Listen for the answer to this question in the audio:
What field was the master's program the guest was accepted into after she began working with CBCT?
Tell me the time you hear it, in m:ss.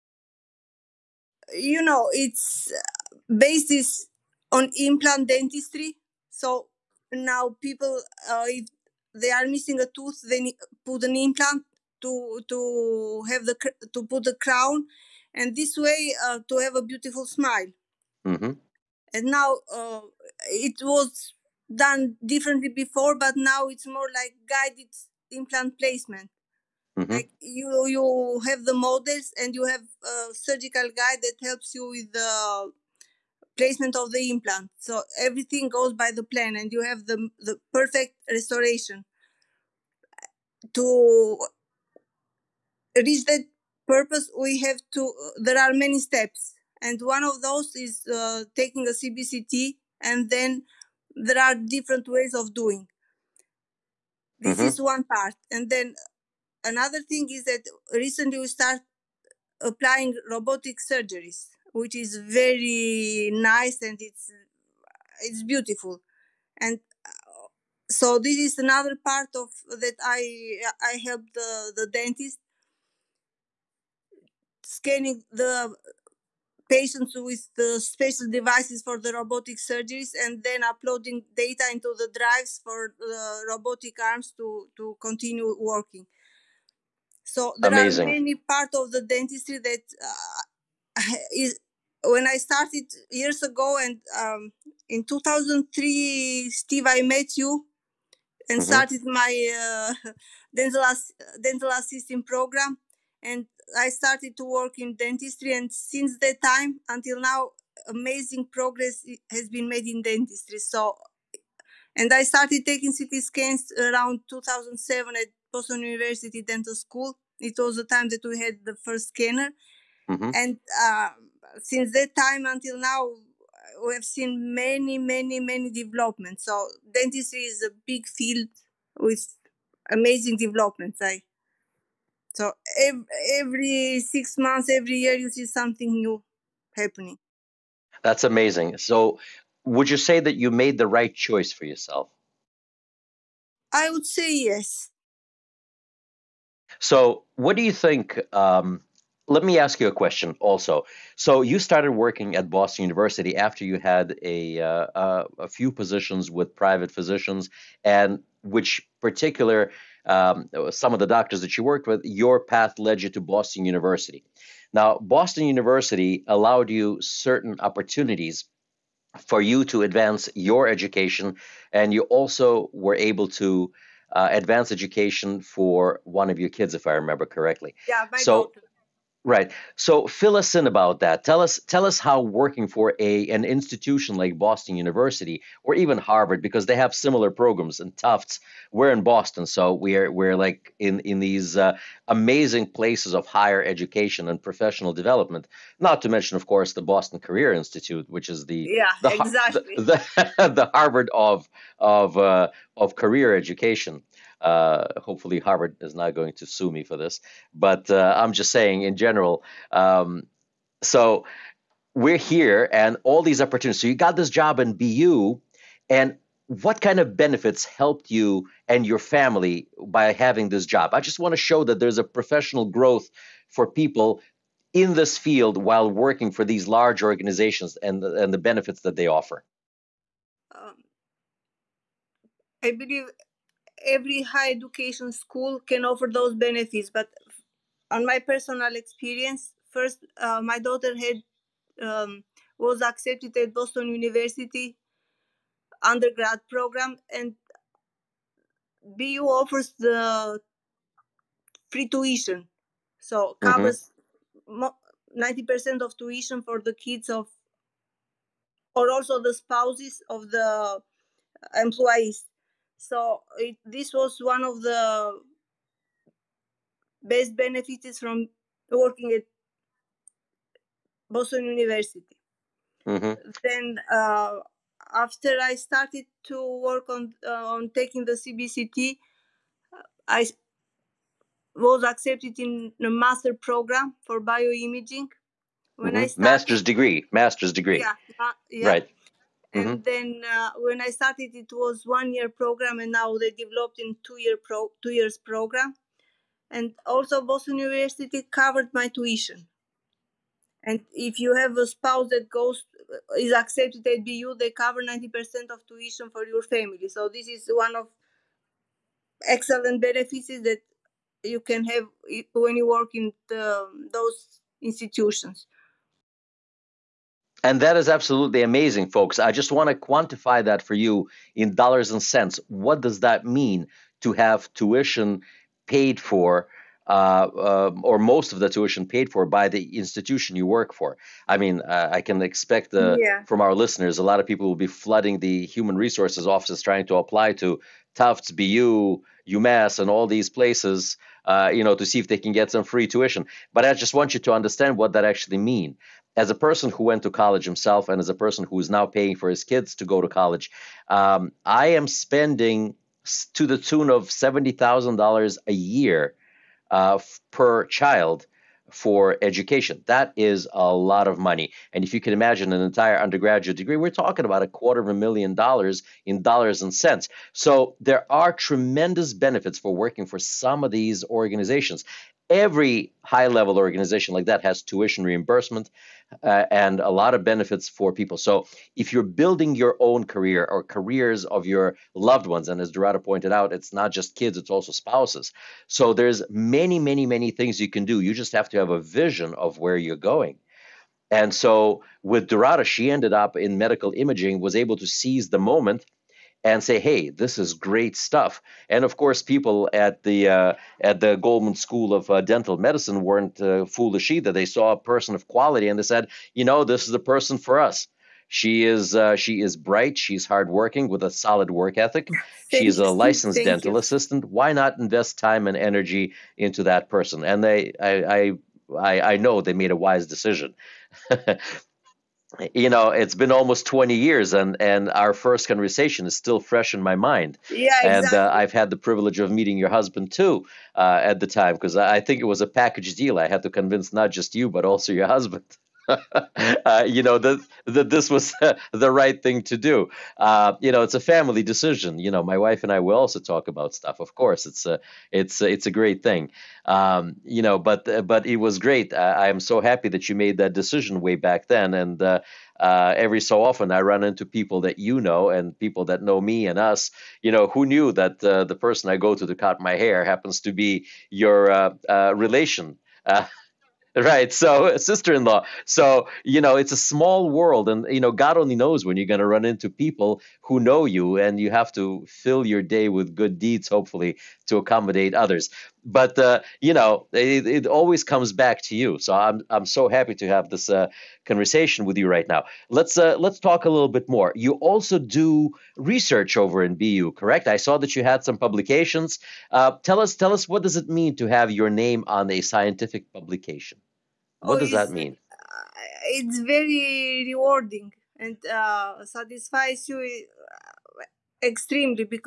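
4:44.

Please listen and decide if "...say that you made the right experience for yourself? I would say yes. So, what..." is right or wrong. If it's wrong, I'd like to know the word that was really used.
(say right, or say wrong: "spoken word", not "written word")
wrong: "choice", not "experience".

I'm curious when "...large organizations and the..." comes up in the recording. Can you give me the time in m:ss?
3:46.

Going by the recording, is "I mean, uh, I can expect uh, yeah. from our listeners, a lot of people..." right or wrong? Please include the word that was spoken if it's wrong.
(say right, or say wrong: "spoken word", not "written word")
right.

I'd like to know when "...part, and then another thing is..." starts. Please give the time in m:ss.
0:55.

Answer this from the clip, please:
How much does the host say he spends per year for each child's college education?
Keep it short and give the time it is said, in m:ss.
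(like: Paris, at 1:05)
$70,000, at 5:54.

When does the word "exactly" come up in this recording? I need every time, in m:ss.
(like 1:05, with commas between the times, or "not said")
3:19, 7:07.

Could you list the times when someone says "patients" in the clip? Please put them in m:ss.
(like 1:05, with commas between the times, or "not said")
1:16.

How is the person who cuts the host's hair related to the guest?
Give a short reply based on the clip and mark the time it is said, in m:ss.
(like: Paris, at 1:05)
Sister-in-law, at 7:44.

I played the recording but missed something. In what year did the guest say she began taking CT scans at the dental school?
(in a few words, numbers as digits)
2007.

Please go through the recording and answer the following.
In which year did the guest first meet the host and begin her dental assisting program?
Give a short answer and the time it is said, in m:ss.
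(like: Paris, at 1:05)
2003, at 1:35.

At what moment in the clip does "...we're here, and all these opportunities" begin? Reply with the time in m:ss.
3:31.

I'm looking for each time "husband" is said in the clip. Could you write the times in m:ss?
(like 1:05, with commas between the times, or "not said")
7:09, 7:15.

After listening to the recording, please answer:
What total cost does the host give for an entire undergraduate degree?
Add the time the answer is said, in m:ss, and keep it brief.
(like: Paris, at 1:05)
A quarter of a million dollars, at 6:04.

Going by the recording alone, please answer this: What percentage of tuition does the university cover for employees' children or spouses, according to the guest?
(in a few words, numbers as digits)
90%.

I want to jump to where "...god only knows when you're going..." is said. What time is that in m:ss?
7:48.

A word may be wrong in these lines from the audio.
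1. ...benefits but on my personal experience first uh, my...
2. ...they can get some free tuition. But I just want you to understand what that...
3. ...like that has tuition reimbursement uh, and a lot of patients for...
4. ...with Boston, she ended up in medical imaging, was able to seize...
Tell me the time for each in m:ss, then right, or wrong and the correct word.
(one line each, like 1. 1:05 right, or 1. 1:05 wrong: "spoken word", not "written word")
1. 3:56 right
2. 5:42 right
3. 6:14 wrong: "benefits", not "patients"
4. 6:32 wrong: "Dhurata", not "Boston".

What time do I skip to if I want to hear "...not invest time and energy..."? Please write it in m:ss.
6:54.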